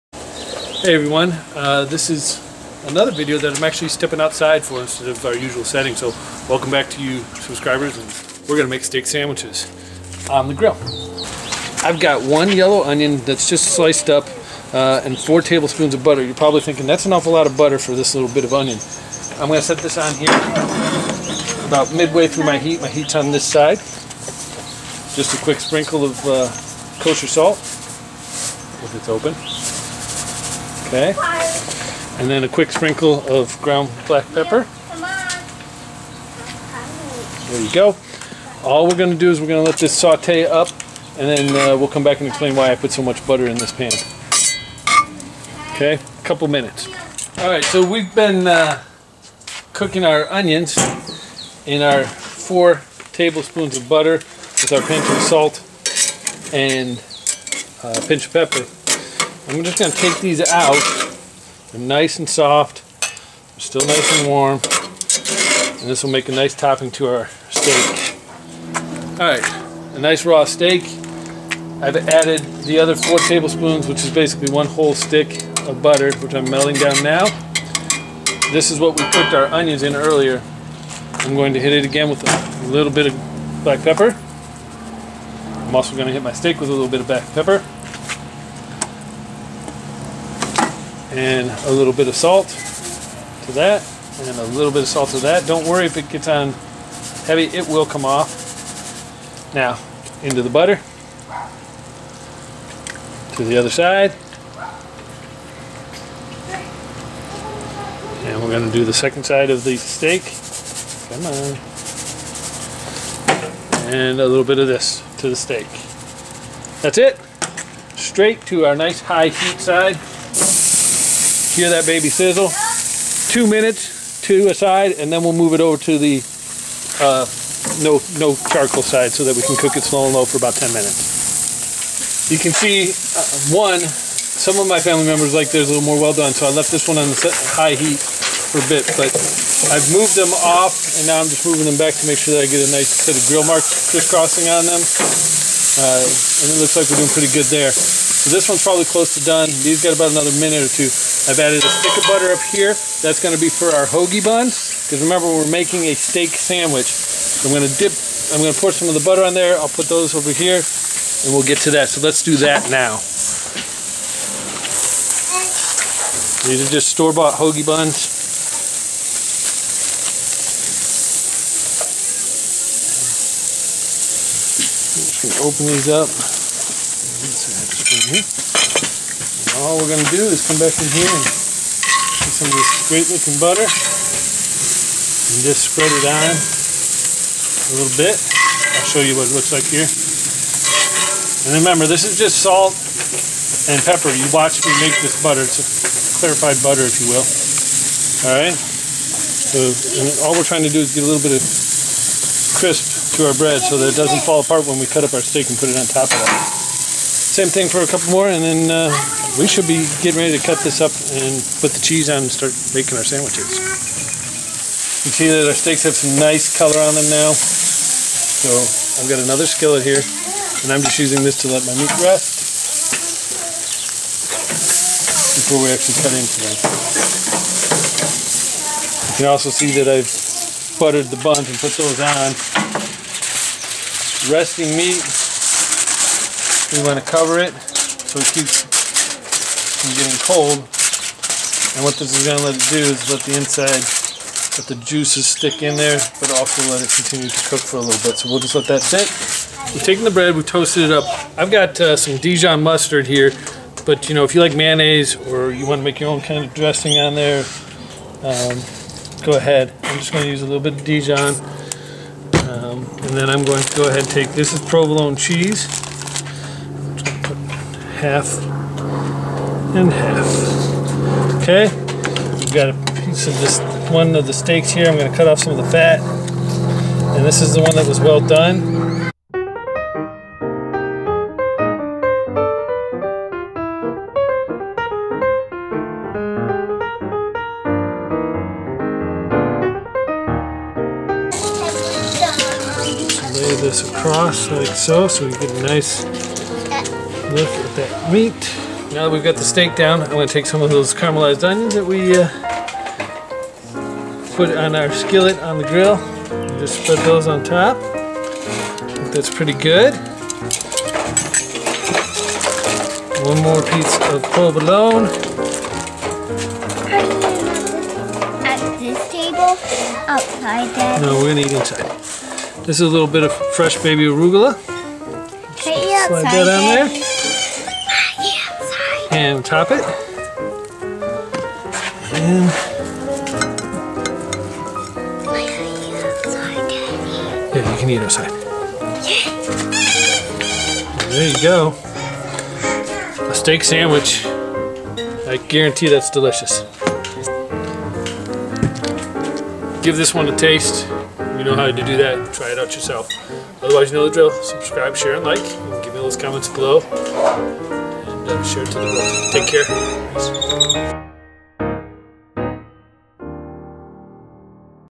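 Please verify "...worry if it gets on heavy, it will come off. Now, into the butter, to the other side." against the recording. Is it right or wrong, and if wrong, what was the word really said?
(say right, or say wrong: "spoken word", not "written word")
right.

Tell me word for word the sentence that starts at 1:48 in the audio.
And we're going to do the second side of the steak.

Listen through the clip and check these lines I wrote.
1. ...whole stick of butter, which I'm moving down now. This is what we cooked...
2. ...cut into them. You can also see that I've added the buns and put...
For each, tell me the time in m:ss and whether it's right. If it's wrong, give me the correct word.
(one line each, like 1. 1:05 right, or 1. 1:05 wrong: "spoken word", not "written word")
1. 1:14 wrong: "melting", not "moving"
2. 3:45 wrong: "buttered", not "added".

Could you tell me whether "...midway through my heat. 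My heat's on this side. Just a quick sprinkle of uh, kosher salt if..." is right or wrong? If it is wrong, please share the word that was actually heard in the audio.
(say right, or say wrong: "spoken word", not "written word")
right.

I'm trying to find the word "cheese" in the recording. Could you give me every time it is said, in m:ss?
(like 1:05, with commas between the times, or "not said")
3:31, 4:25.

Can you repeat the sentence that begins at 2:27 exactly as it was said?
So this one's probably close to done.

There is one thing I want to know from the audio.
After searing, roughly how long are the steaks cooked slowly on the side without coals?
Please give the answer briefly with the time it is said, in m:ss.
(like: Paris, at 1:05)
10 minutes, at 2:10.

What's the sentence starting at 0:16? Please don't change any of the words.
You're probably thinking that's an awful lot of butter for this little bit of onion.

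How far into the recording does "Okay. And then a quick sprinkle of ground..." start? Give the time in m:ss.
0:30.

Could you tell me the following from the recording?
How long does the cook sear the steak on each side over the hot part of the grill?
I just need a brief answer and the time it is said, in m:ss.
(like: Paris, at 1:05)
2 minutes, at 2:03.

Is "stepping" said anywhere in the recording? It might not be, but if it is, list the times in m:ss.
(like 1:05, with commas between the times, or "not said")
0:03.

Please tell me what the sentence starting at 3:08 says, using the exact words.
I'll show you what it looks like here.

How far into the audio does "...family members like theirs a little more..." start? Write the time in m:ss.
2:14.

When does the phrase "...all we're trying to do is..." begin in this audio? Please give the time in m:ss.
3:20.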